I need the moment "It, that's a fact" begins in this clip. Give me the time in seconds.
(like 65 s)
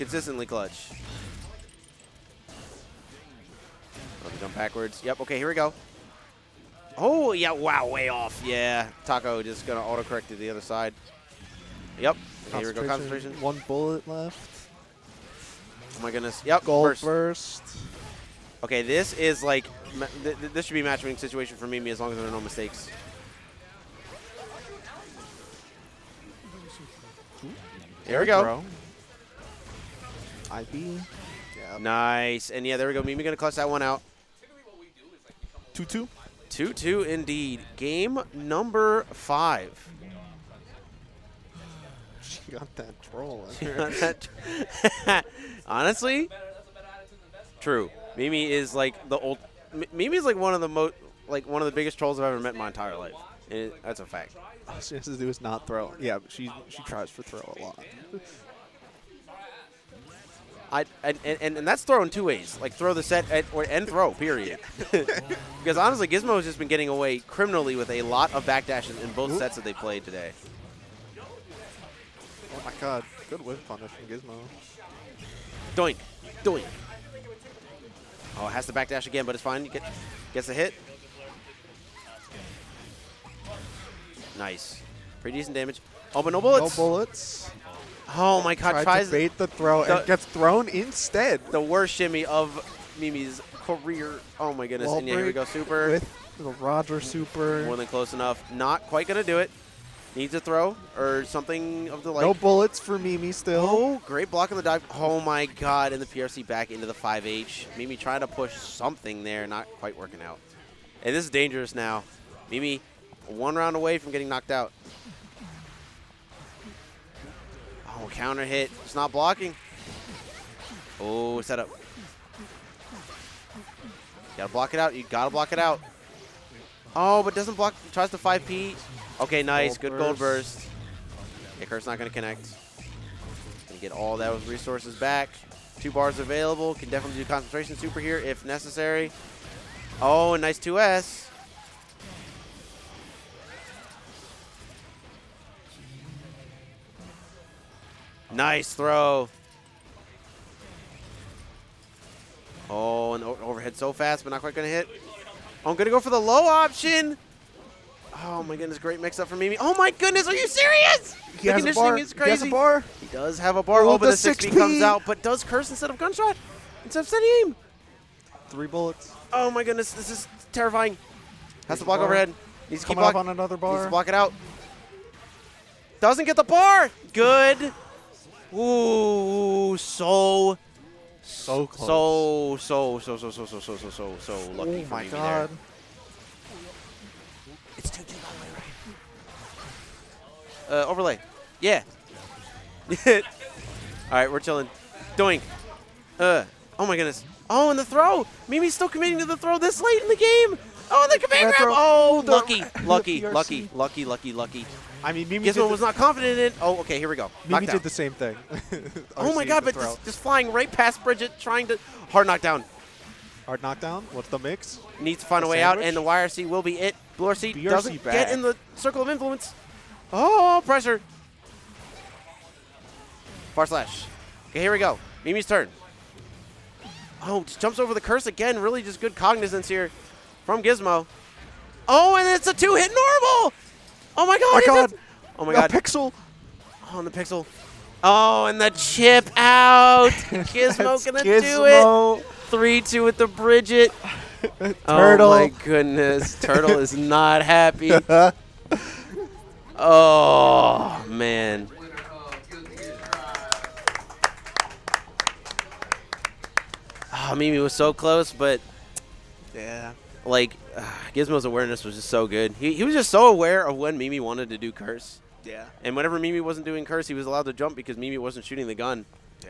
53 s.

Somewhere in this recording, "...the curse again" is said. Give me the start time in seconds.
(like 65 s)
227 s.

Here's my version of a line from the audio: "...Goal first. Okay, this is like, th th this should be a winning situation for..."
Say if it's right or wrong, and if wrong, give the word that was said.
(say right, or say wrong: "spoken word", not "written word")
right.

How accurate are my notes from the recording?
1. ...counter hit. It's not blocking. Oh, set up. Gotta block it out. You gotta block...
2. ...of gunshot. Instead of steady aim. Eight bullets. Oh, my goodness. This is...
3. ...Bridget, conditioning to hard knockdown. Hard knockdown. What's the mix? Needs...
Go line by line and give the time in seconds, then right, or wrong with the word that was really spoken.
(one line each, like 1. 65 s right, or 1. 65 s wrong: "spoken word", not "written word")
1. 118 s right
2. 165 s wrong: "Three", not "Eight"
3. 211 s wrong: "trying", not "conditioning".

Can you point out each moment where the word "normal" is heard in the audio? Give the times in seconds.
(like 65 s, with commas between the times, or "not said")
232 s.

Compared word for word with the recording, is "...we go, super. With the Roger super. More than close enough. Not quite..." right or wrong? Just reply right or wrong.
right.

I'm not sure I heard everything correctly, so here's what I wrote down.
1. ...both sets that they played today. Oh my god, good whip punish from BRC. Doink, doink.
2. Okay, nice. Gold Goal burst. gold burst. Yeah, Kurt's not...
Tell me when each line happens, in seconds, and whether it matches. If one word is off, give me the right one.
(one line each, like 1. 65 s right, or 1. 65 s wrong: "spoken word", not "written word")
1. 69 s wrong: "Gizmo", not "BRC"
2. 129 s wrong: "Good", not "Goal".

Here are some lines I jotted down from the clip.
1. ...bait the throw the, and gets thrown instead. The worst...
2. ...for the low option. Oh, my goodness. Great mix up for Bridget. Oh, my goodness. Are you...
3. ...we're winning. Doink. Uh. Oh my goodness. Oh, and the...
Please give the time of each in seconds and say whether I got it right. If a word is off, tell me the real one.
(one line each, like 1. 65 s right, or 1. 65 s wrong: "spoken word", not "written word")
1. 89 s right
2. 156 s wrong: "Mimi", not "Bridget"
3. 194 s wrong: "chilling", not "winning".